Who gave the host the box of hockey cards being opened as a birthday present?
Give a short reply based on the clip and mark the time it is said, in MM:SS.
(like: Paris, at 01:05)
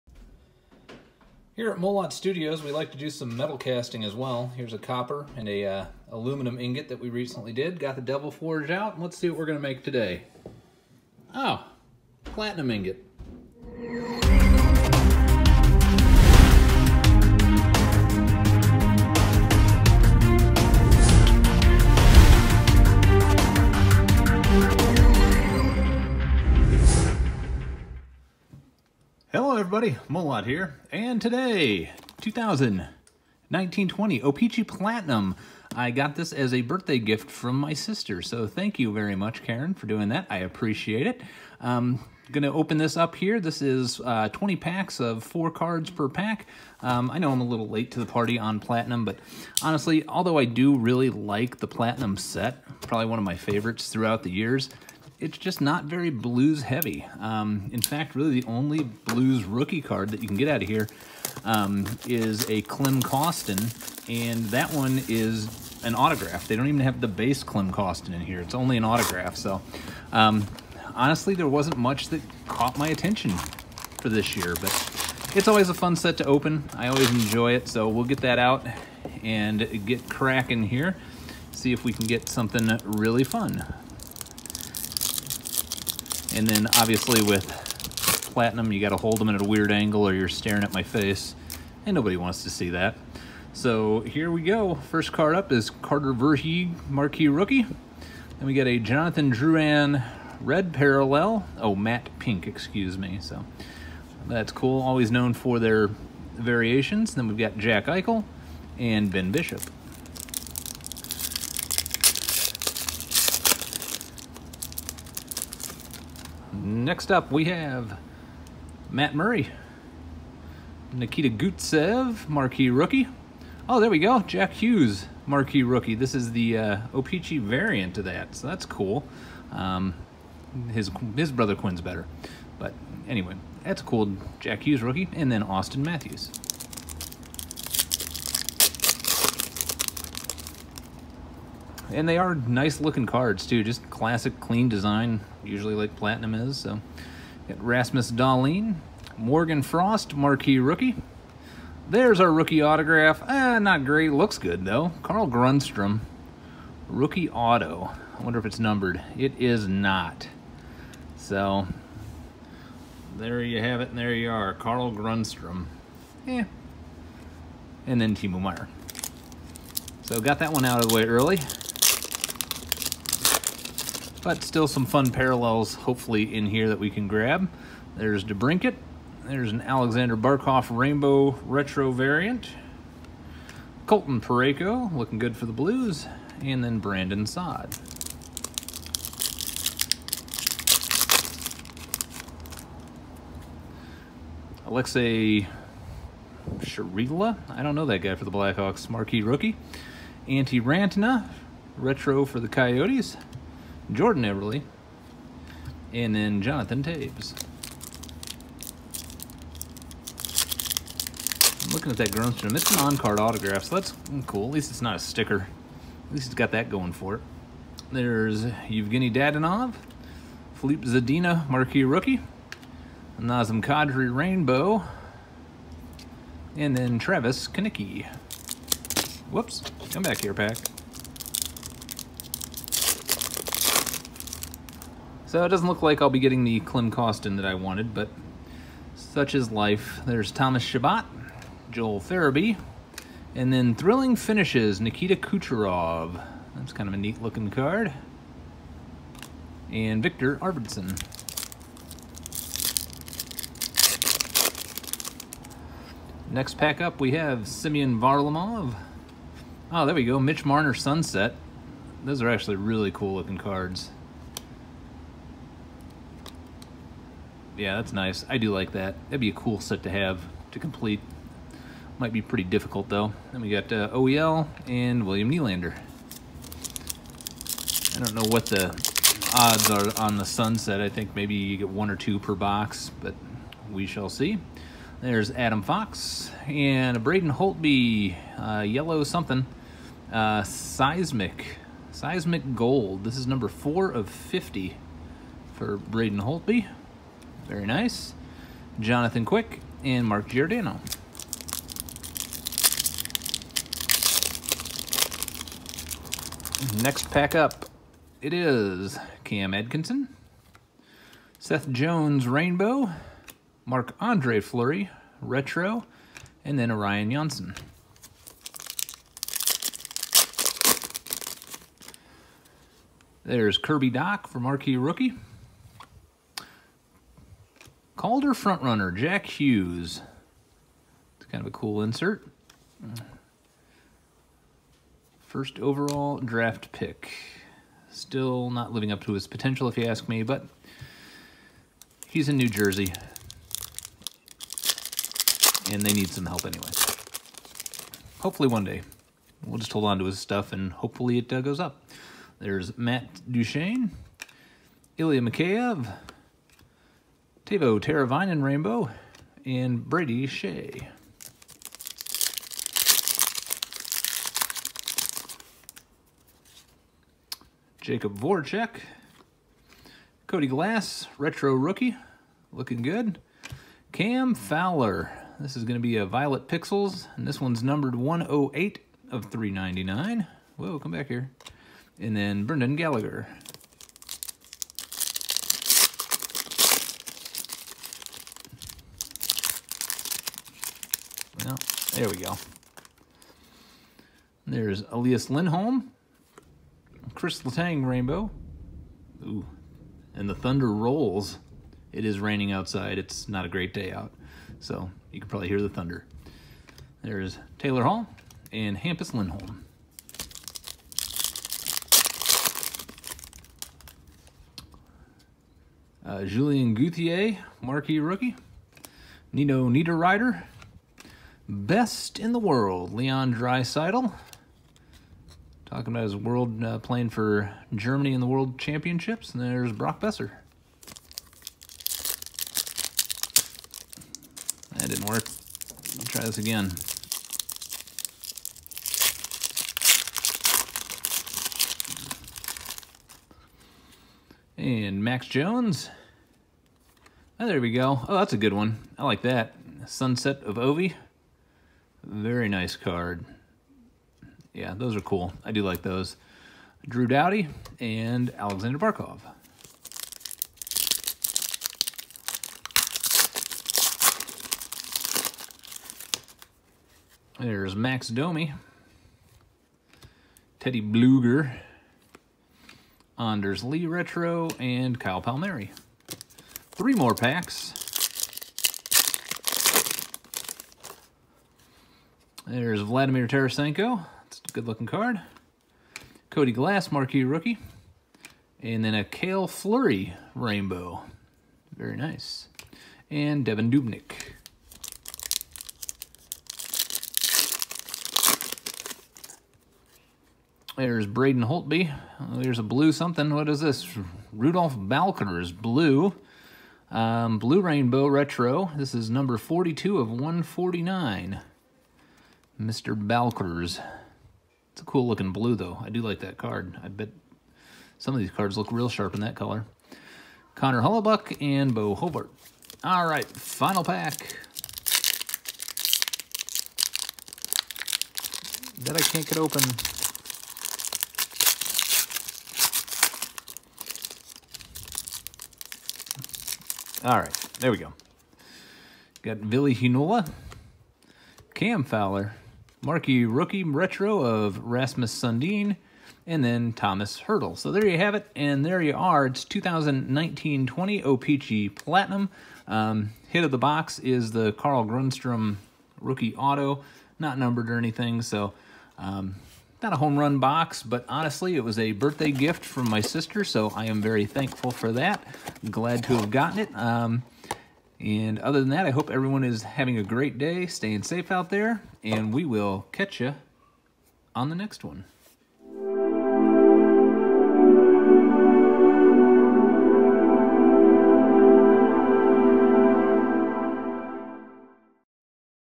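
Karen, at 00:39.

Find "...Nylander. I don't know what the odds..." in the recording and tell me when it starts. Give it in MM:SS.
04:35.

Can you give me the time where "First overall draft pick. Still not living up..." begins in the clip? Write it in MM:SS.
05:35.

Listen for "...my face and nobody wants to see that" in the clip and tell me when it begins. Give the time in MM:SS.
01:30.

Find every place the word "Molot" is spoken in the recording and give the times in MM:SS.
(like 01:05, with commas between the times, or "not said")
00:01, 00:30.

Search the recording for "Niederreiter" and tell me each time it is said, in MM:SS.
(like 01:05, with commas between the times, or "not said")
06:59.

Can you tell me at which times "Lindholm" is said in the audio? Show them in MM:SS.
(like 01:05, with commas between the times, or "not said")
06:35, 06:49.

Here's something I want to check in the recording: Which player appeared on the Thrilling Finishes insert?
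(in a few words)
Nikita Kucherov.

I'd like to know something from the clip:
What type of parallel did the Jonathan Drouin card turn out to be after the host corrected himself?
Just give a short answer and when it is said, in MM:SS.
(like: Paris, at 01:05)
matte pink, at 01:41.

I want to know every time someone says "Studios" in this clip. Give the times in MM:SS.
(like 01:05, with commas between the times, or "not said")
00:02.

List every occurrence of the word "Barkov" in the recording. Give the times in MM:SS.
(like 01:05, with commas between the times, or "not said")
03:00, 07:38.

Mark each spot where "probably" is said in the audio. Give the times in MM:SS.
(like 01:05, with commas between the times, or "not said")
00:52, 06:45.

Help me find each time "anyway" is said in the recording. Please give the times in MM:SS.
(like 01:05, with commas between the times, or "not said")
02:13, 05:46.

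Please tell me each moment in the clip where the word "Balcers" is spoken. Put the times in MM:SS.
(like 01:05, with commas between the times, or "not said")
08:24, 08:32.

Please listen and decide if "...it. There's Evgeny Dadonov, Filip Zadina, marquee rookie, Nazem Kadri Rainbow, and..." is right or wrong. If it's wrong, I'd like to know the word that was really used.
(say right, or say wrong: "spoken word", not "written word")
right.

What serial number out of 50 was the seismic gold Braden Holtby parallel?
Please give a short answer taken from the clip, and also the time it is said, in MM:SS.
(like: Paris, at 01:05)
4, at 04:53.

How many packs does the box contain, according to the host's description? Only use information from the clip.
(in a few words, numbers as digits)
20.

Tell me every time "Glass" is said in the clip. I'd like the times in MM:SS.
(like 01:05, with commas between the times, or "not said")
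06:10, 08:06.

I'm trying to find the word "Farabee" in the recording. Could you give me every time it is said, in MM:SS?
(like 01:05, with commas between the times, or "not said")
04:02.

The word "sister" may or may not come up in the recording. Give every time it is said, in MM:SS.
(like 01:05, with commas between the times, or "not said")
00:37, 09:23.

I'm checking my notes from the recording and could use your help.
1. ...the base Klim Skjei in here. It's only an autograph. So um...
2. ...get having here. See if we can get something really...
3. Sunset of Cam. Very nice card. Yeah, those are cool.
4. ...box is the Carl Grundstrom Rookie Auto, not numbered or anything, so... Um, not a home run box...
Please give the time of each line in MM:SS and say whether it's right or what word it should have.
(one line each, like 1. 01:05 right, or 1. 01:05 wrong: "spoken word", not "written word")
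1. 01:07 wrong: "Kostin", not "Skjei"
2. 01:19 wrong: "cracking", not "having"
3. 07:29 wrong: "Ovi", not "Cam"
4. 09:13 right.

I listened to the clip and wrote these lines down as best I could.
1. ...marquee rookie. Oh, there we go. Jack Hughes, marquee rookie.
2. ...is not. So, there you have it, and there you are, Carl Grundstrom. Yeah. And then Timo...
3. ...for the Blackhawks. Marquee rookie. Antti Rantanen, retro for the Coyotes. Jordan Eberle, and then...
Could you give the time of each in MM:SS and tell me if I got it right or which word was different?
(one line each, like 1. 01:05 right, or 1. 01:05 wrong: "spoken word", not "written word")
1. 02:02 right
2. 02:39 right
3. 03:18 right.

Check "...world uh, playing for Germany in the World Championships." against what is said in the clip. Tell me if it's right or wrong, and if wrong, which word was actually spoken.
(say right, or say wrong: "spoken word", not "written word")
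right.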